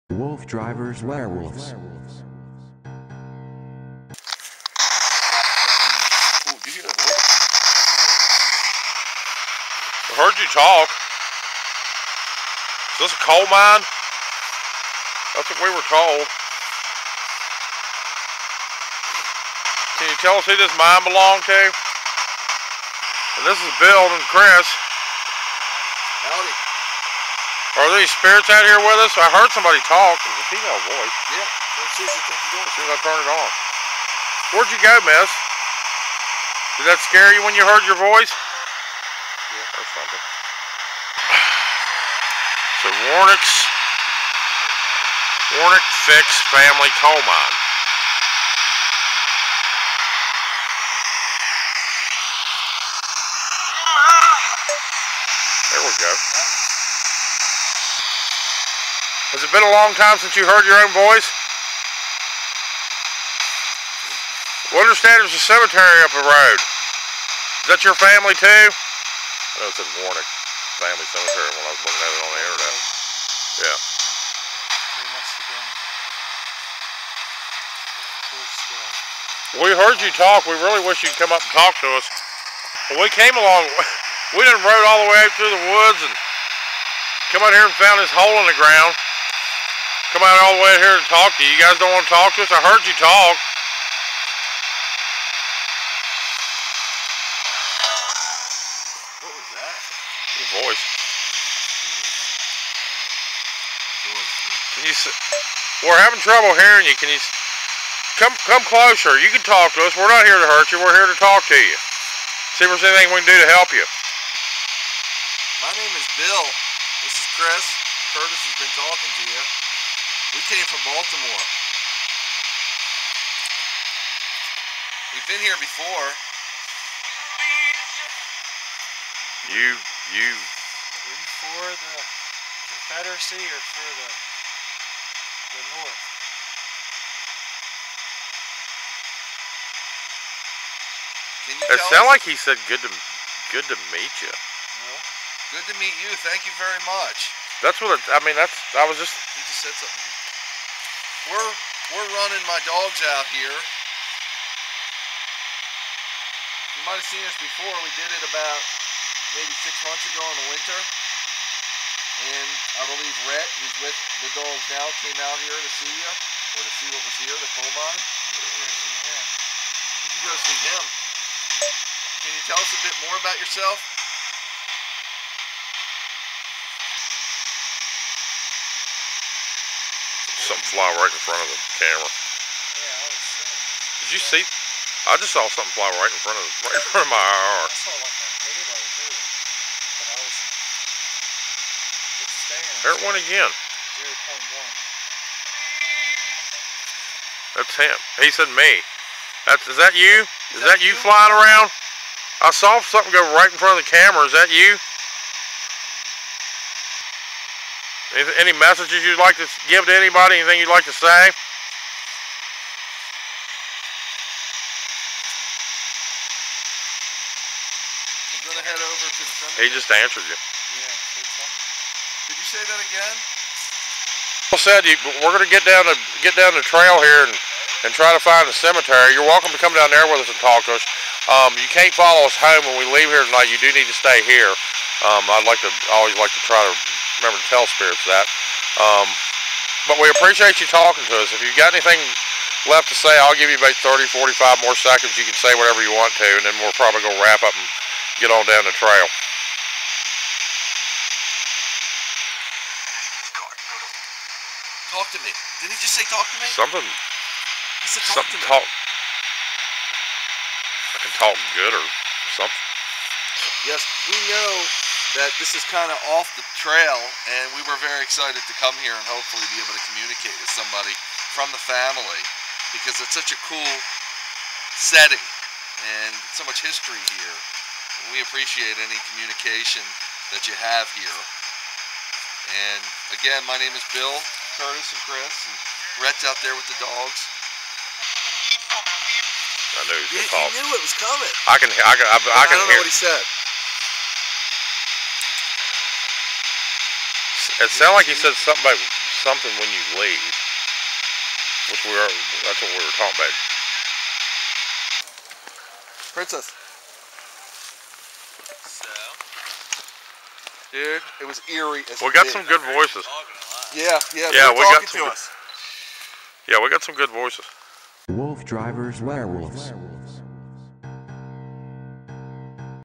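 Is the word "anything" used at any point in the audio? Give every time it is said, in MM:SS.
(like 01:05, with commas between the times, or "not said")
01:52, 03:30, 04:01.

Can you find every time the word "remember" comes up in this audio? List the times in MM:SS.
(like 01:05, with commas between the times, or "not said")
03:57.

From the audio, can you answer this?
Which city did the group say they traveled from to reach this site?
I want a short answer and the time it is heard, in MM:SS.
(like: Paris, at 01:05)
Baltimore, at 02:00.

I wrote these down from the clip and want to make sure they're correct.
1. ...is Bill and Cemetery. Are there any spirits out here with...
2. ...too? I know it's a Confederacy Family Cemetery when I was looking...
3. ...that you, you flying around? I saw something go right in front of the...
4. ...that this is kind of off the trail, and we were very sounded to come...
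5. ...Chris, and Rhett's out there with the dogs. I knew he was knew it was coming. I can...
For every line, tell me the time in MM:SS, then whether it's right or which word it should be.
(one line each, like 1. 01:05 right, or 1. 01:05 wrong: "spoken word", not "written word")
1. 00:23 wrong: "Chris", not "Cemetery"
2. 01:08 wrong: "Warnick", not "Confederacy"
3. 03:20 right
4. 04:25 wrong: "excited", not "sounded"
5. 04:45 right.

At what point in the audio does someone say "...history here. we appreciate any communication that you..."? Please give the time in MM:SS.
04:36.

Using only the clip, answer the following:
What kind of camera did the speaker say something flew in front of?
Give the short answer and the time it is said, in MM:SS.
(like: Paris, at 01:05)
IR, at 03:07.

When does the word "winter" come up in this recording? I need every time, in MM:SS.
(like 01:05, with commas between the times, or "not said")
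02:40.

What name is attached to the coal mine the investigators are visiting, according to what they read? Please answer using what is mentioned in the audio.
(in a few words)
Warnick Fickes.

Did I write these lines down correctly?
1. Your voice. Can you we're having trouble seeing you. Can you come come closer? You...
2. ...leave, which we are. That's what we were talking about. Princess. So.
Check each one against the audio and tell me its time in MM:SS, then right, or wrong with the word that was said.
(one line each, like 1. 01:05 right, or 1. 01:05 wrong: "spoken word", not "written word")
1. 01:40 wrong: "hearing", not "seeing"
2. 05:00 right.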